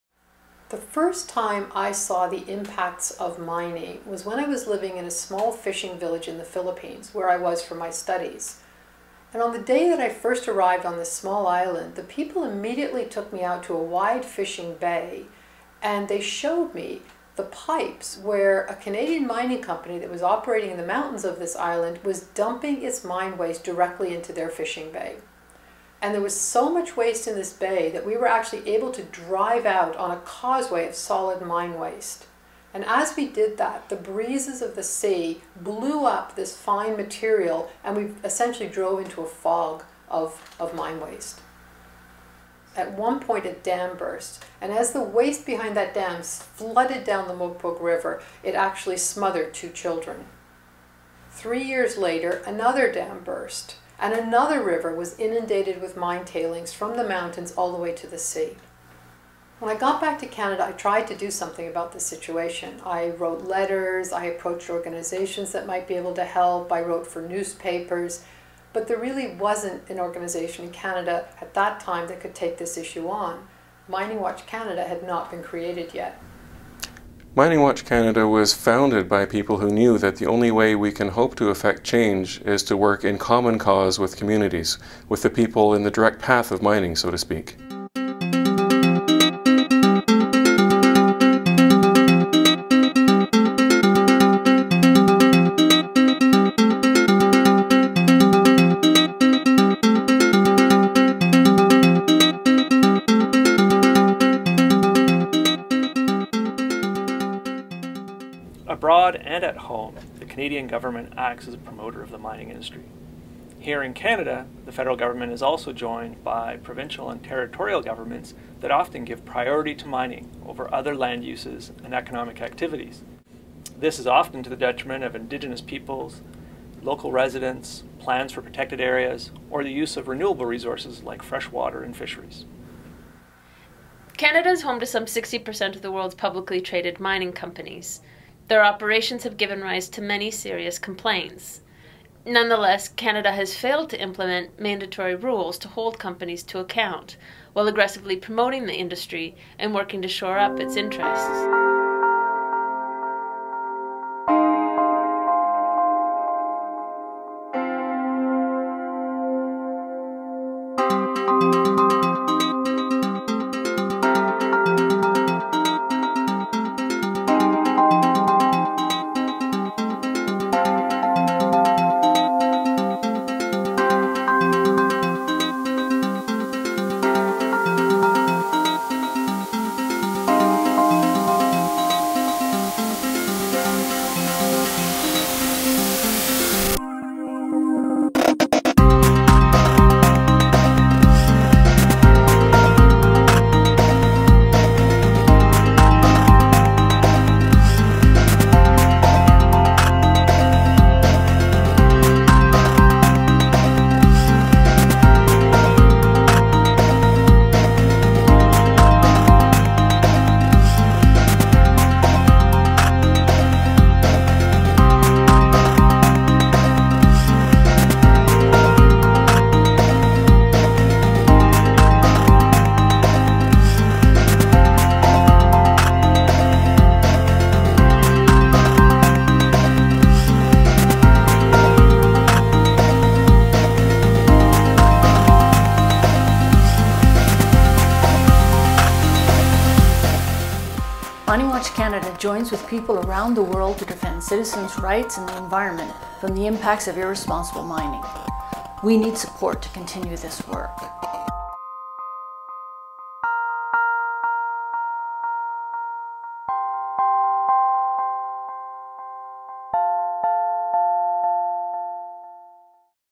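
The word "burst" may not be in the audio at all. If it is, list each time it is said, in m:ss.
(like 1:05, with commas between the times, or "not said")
0:43, 0:53.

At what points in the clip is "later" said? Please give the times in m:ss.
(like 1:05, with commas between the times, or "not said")
0:51.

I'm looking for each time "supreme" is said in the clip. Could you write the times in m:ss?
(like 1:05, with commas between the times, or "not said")
not said.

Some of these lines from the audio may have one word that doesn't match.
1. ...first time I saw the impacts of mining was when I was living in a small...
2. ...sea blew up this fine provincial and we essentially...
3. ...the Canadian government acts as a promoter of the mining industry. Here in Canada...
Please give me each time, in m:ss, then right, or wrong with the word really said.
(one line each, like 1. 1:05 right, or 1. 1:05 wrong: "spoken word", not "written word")
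1. 0:00 right
2. 0:34 wrong: "material", not "provincial"
3. 1:50 right.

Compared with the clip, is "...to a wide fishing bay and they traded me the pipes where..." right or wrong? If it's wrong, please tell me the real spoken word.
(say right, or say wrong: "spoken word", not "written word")
wrong: "showed", not "traded".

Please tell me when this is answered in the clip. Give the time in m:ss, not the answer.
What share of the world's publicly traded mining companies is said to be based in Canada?
2:15.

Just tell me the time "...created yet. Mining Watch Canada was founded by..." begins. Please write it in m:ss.
1:15.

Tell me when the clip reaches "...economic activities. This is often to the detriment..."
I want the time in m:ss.
2:01.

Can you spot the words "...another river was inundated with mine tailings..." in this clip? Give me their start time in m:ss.
0:54.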